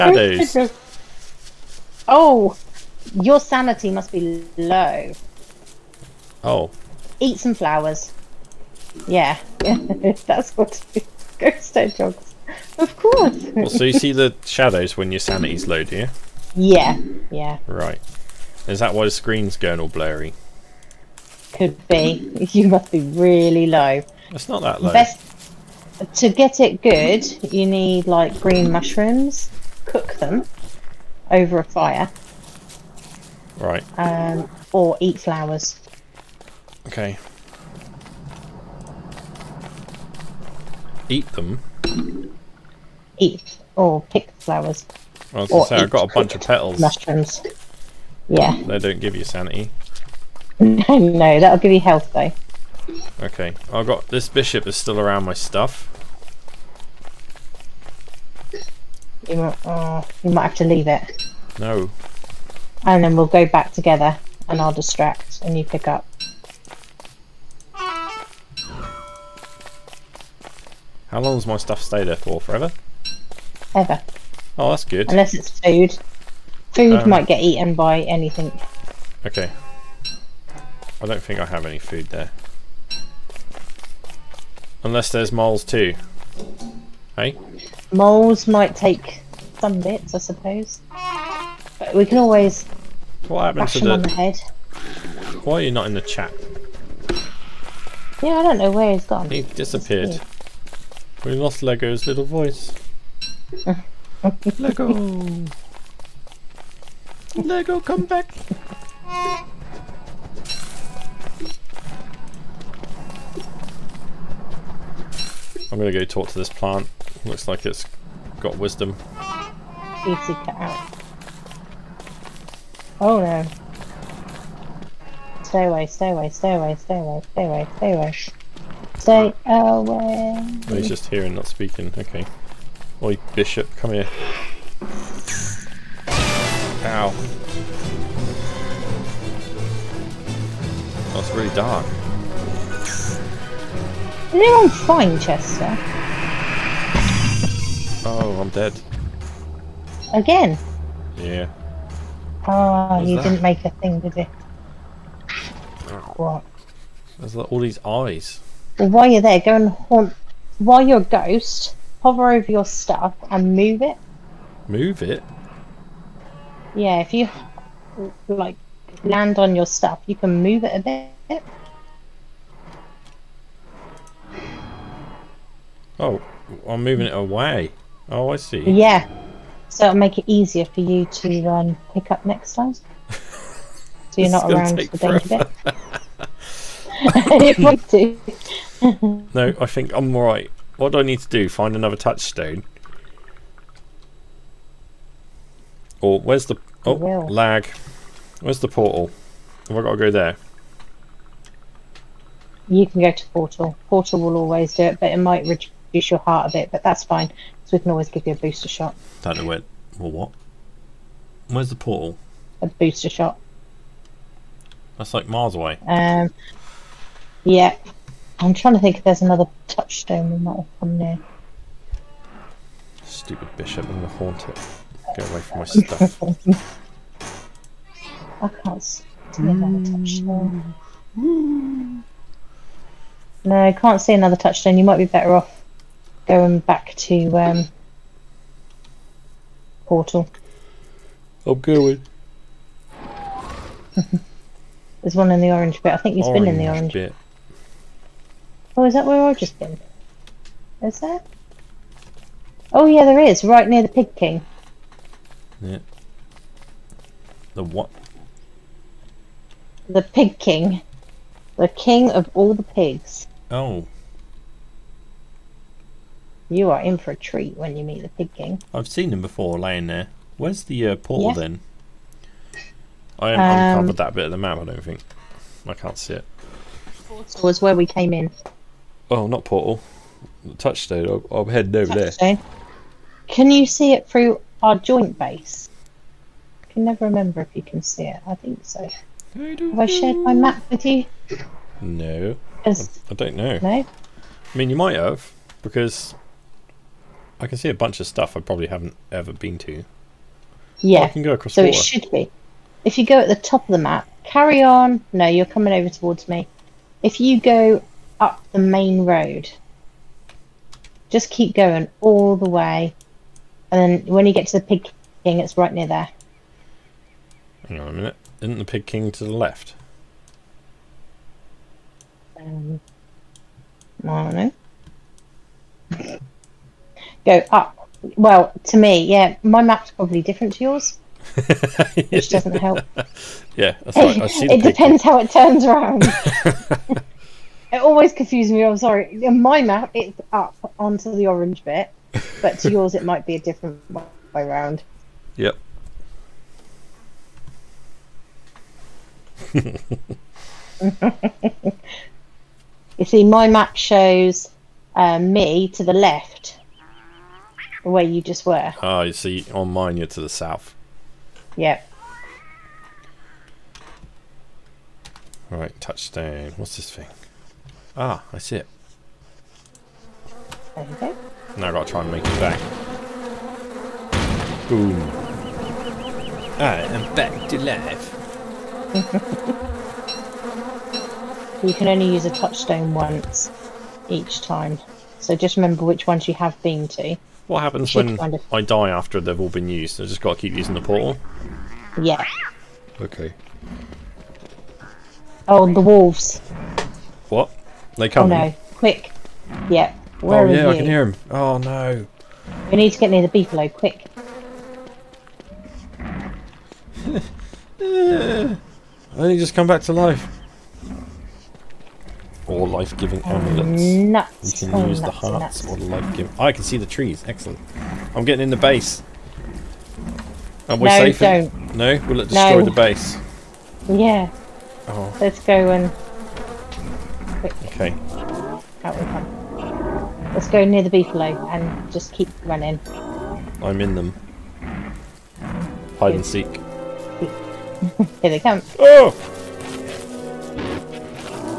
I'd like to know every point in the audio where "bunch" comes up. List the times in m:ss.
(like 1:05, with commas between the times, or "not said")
0:46, 4:57.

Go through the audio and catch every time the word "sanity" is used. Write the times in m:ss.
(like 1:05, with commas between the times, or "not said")
0:03, 0:15, 0:49.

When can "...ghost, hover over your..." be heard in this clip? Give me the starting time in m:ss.
2:41.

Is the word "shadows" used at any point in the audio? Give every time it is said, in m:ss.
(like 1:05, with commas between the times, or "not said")
0:00, 0:14.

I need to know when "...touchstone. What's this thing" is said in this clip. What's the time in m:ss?
6:05.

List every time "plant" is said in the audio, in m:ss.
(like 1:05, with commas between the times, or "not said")
1:56.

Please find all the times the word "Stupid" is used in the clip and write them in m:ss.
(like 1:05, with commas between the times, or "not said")
3:43.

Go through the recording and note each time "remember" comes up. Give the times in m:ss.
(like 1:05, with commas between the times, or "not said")
4:47, 6:25.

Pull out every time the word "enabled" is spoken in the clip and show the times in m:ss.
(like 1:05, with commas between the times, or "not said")
not said.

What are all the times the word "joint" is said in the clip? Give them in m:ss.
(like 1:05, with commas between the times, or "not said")
4:44.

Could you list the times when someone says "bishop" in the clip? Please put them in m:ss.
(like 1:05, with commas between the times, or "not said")
0:54, 2:13, 3:43.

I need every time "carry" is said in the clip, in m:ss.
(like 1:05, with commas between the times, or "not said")
5:04.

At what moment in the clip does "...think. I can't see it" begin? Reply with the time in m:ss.
4:34.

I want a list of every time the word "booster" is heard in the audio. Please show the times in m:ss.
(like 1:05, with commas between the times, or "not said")
3:28, 3:32.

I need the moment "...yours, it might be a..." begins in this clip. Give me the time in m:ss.
5:42.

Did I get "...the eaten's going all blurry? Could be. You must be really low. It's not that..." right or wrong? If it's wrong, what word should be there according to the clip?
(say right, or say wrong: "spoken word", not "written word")
wrong: "screen", not "eaten".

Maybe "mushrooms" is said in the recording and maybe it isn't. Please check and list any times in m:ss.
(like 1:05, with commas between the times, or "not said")
0:28, 0:46.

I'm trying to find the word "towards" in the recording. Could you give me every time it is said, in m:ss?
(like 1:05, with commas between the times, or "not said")
5:05.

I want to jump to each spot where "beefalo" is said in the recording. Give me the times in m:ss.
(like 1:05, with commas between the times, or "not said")
6:43, 7:10.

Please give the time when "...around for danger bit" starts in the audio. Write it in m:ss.
3:04.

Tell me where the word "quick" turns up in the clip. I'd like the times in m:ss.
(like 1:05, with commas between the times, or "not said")
6:38, 6:43, 7:07.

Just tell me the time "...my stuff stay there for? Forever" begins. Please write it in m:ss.
1:11.